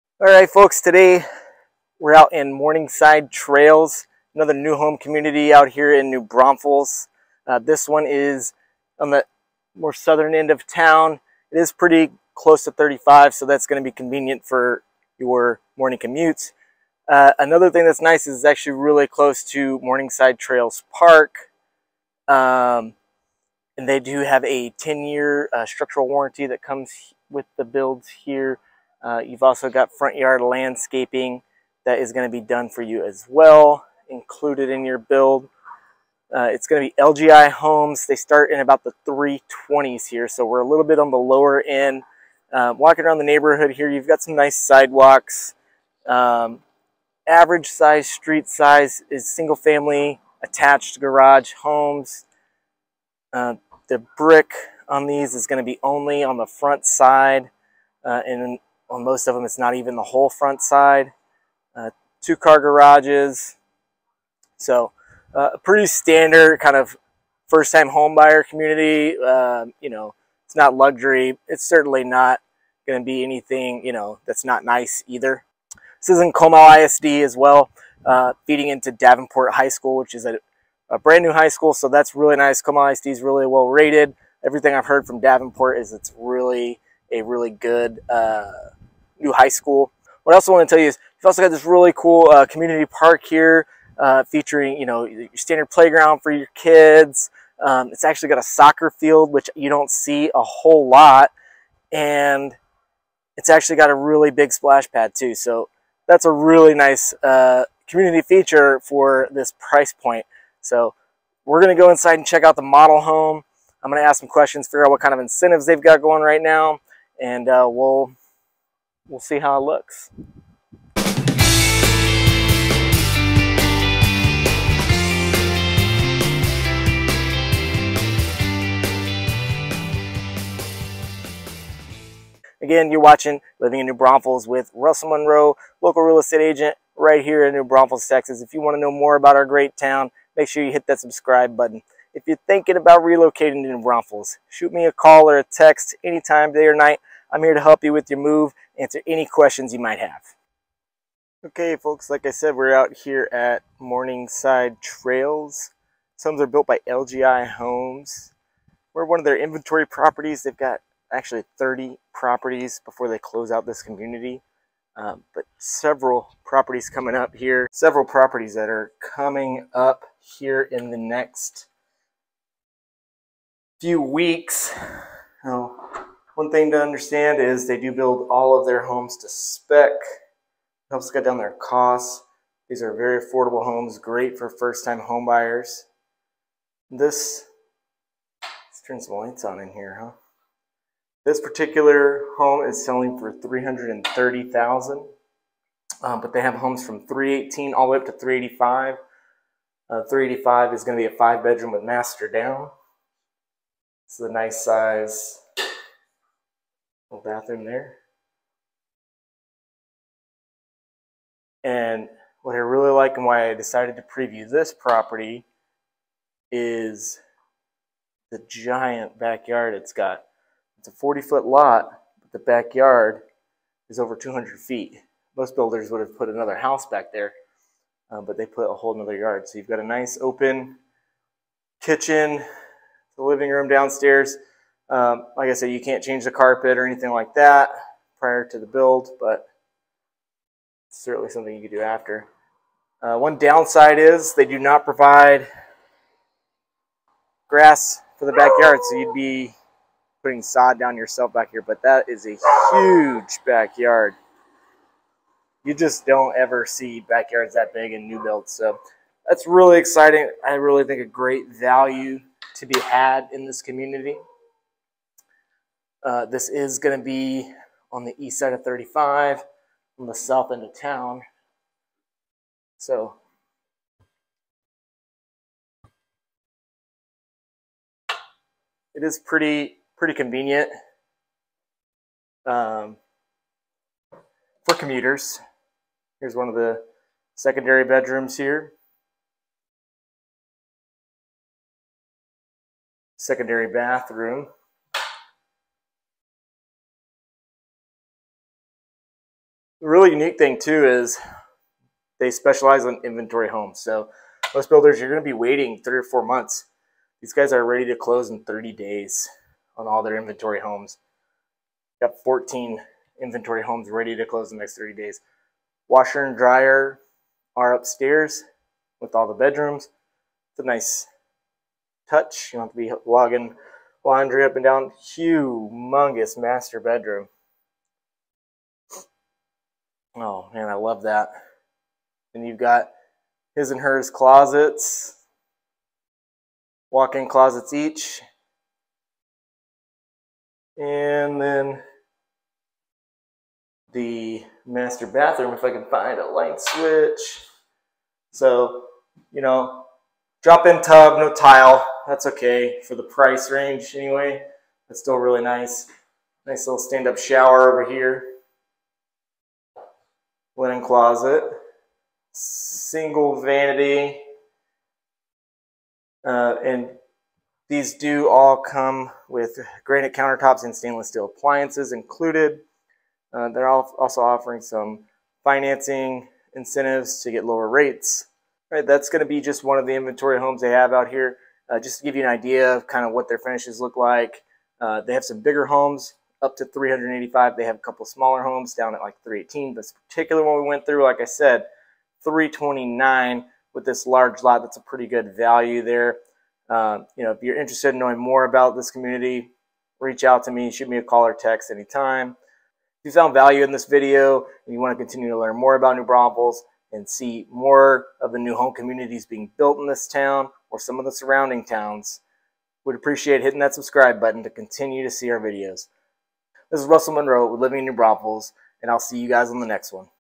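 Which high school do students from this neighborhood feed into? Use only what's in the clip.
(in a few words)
Davenport High School.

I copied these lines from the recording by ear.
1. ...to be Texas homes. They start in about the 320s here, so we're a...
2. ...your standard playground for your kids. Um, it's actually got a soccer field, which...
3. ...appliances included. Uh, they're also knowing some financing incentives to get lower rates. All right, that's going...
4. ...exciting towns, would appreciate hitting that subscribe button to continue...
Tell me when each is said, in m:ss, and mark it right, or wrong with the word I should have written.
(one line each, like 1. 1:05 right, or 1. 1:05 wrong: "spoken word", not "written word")
1. 0:36 wrong: "LGI", not "Texas"
2. 1:35 right
3. 6:11 wrong: "offering", not "knowing"
4. 6:51 wrong: "surrounding", not "exciting".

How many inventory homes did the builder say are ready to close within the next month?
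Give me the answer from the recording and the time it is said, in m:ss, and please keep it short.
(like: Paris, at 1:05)
14, at 5:12.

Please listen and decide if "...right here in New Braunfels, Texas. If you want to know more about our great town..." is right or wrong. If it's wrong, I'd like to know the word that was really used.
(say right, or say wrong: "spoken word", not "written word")
right.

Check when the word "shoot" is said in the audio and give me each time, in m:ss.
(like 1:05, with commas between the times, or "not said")
2:24, 6:40.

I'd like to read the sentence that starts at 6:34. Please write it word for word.
That's a pretty good value there.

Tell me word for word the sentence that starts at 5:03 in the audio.
So most builders, you're going to be waiting three or four months.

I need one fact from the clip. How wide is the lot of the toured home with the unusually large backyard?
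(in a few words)
40 feet.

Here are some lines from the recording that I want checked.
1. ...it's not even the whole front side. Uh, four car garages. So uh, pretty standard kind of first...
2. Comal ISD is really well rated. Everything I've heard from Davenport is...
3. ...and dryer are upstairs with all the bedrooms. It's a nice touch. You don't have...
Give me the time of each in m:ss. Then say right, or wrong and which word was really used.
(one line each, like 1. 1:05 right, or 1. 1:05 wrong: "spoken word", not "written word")
1. 0:59 wrong: "two", not "four"
2. 1:22 right
3. 5:16 right.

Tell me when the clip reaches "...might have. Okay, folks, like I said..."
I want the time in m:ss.
2:29.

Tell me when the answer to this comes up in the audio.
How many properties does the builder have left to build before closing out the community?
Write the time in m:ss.
2:41.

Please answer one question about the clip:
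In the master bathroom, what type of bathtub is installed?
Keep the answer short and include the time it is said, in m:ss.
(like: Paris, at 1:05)
Drop-in tub, at 5:50.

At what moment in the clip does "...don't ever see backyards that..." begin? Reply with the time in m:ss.
4:16.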